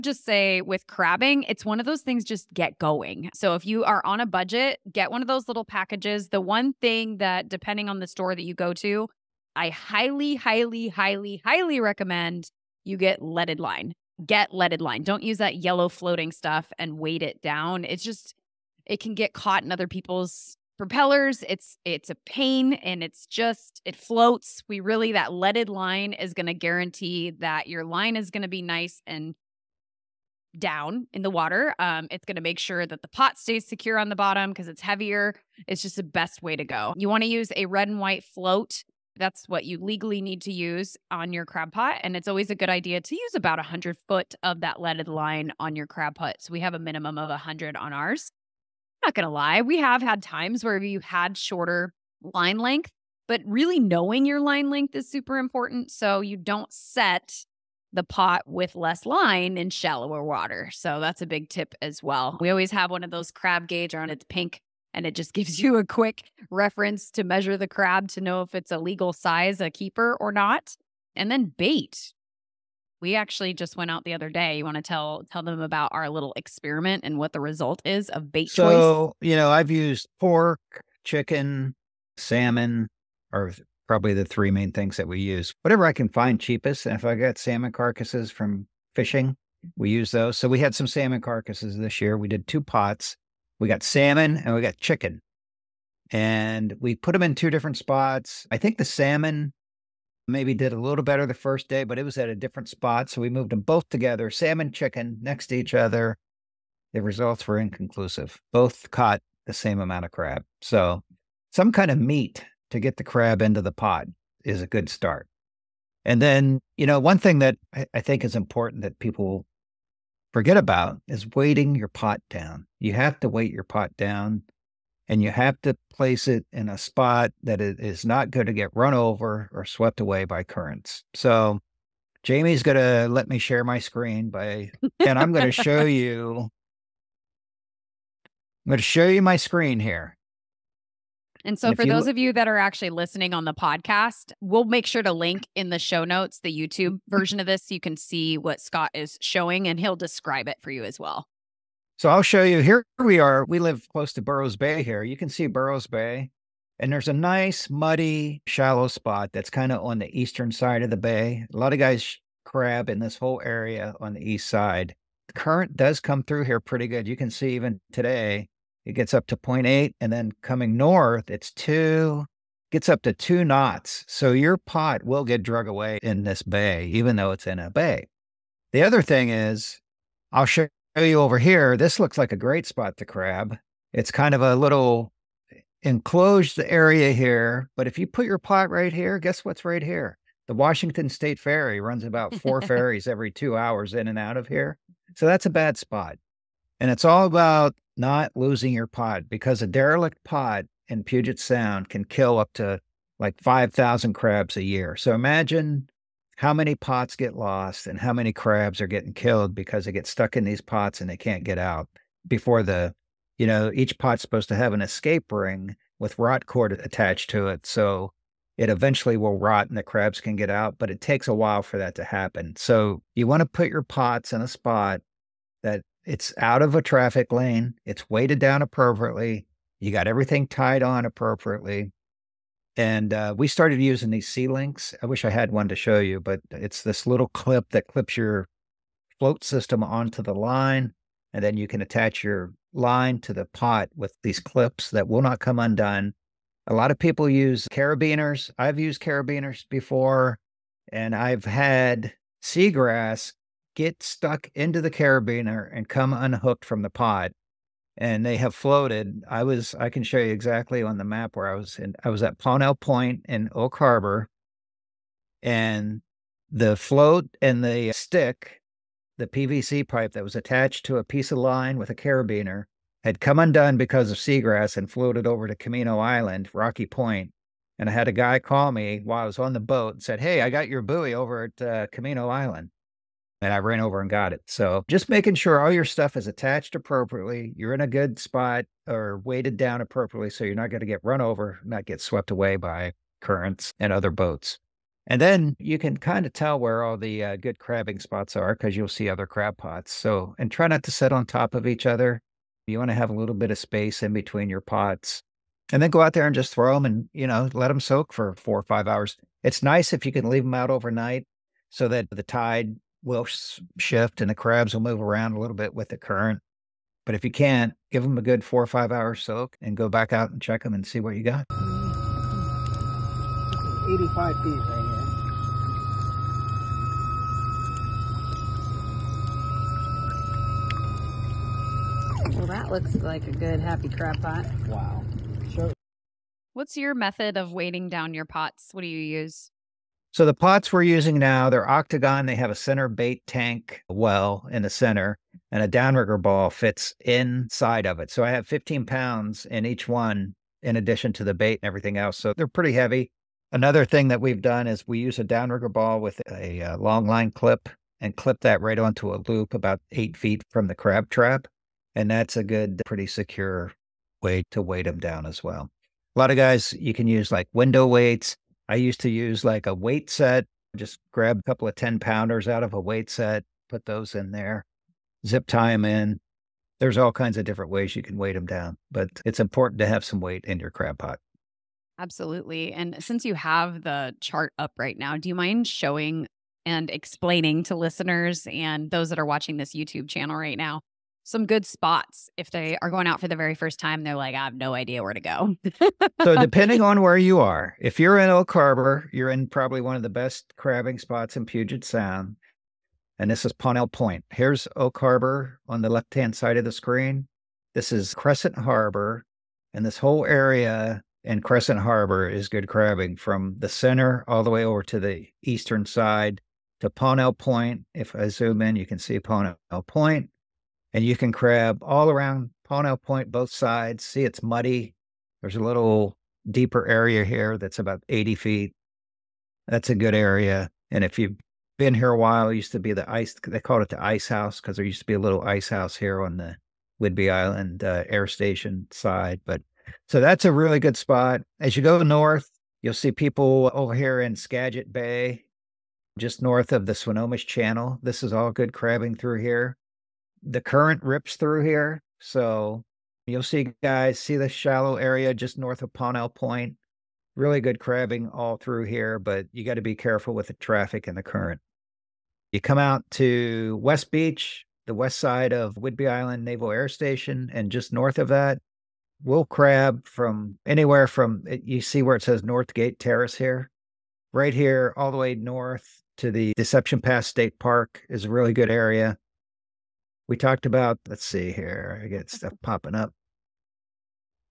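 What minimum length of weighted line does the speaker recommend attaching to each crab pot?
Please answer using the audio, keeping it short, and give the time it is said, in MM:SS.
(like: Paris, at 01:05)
100 feet, at 00:43.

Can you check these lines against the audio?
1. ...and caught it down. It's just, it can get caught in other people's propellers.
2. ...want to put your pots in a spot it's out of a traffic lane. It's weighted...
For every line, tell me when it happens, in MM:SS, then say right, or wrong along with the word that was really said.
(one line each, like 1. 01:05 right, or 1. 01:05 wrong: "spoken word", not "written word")
1. 00:16 wrong: "weight", not "caught"
2. 03:43 right.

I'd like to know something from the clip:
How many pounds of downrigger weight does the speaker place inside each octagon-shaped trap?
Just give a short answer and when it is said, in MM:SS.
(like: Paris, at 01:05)
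15 pounds, at 05:48.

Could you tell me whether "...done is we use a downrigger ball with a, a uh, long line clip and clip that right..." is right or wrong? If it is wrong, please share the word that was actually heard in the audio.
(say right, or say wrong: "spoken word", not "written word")
right.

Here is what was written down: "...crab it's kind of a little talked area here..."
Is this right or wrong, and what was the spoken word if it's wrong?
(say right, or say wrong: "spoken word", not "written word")
wrong: "enclosed", not "talked".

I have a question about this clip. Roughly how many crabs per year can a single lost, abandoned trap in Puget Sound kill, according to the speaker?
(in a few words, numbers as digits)
5,000.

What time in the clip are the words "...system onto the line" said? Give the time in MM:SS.
03:59.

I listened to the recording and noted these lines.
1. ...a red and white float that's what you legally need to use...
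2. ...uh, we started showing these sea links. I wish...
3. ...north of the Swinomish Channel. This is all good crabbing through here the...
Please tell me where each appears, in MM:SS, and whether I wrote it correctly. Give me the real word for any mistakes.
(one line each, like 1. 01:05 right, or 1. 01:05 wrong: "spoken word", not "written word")
1. 00:37 right
2. 03:53 wrong: "using", not "showing"
3. 07:26 right.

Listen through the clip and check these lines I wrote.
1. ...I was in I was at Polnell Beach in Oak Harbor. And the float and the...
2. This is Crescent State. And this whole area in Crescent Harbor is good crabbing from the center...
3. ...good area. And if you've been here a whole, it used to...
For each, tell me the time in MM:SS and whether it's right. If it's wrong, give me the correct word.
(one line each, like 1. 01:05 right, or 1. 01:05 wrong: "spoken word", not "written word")
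1. 04:21 wrong: "Point", not "Beach"
2. 06:47 wrong: "Harbor", not "State"
3. 07:09 wrong: "while", not "whole".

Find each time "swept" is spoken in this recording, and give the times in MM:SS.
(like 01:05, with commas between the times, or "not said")
02:09, 04:52.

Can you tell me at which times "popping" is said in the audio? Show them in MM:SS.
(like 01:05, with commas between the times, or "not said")
08:02.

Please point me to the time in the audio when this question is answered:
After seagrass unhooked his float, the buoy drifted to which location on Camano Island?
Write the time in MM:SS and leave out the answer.
04:36.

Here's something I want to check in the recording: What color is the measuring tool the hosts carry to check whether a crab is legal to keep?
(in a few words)
Pink.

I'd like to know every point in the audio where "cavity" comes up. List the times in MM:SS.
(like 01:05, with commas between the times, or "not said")
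not said.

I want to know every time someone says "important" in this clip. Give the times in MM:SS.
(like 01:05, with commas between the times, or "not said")
00:55, 01:58, 06:19.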